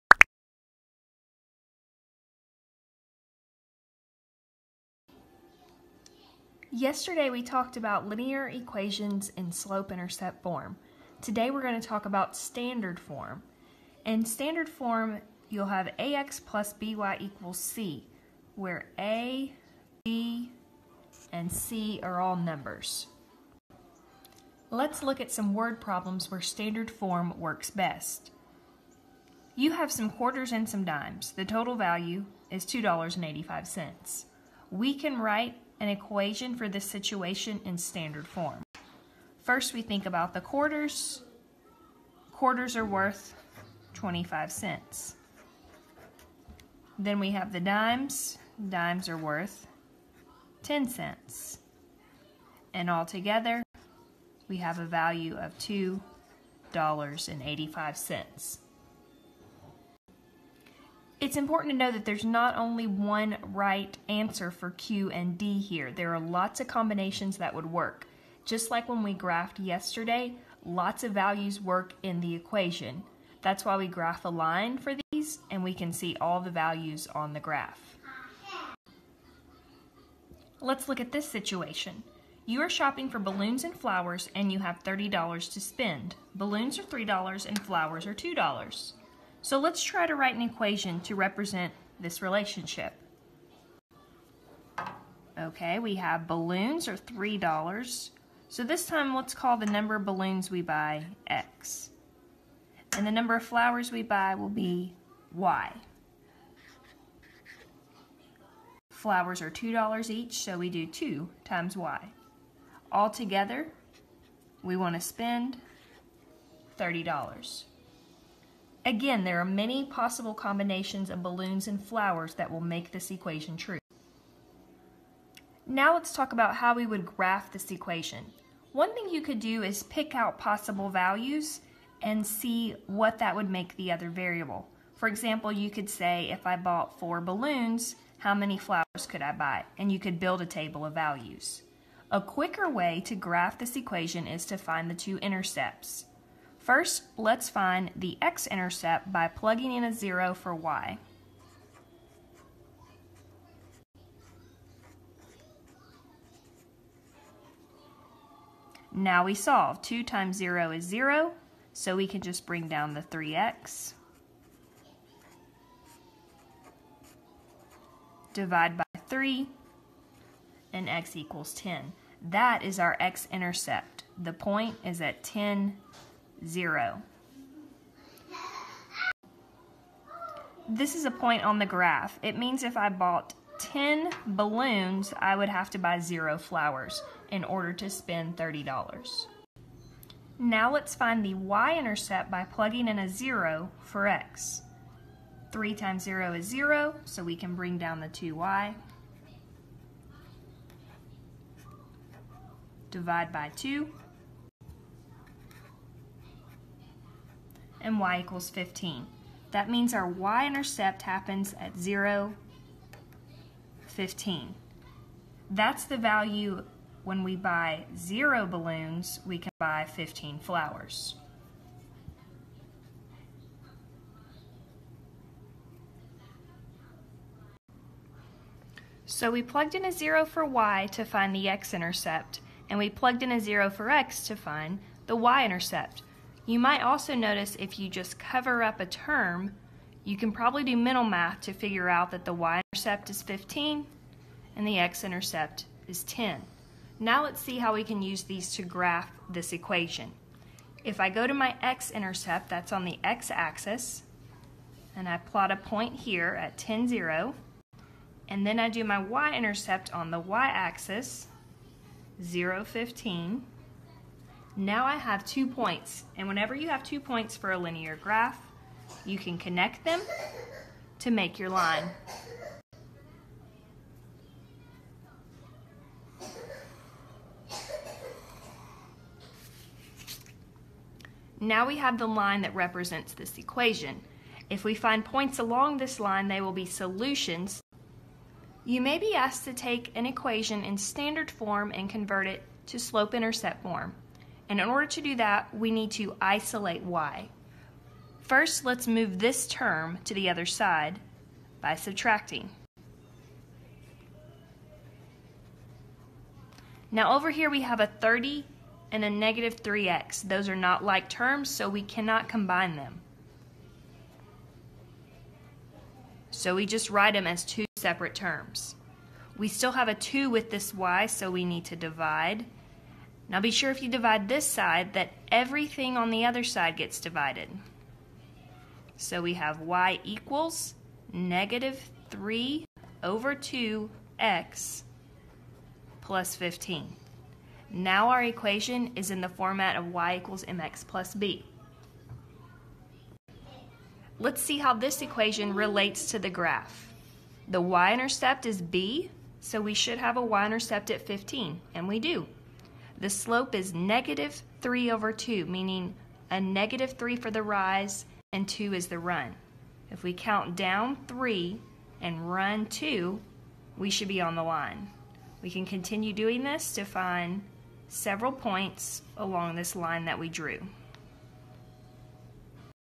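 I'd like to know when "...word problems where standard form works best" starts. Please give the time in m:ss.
0:25.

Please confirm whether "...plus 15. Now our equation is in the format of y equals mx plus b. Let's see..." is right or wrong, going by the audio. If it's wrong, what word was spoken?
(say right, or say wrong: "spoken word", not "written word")
right.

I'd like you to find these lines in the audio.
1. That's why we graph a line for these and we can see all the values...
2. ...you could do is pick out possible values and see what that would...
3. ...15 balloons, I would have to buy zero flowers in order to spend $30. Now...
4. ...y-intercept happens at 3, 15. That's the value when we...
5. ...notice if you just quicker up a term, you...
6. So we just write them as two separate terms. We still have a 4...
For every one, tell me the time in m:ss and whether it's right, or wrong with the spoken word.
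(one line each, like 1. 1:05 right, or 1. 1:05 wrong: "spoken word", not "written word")
1. 1:13 right
2. 2:09 right
3. 3:03 wrong: "10", not "15"
4. 3:30 wrong: "0", not "3"
5. 3:57 wrong: "cover", not "quicker"
6. 5:16 wrong: "2", not "4".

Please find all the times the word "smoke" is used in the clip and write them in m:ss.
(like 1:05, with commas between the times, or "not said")
not said.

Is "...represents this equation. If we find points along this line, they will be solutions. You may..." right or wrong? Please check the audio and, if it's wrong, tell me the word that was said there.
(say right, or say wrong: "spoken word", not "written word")
right.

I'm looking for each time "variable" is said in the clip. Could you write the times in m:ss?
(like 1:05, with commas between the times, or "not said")
2:14.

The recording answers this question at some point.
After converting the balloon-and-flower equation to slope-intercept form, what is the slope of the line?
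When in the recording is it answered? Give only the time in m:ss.
5:53.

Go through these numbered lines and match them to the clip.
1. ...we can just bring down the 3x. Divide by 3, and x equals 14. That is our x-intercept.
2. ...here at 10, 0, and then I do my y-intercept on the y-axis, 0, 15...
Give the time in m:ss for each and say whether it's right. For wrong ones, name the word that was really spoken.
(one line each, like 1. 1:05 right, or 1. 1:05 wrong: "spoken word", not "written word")
1. 2:41 wrong: "10", not "14"
2. 4:15 right.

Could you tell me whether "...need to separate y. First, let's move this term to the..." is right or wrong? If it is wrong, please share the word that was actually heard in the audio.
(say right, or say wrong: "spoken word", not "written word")
wrong: "isolate", not "separate".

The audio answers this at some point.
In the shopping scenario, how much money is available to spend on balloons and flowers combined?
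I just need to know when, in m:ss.
1:24.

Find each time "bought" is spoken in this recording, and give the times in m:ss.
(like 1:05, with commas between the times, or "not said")
2:16, 3:02.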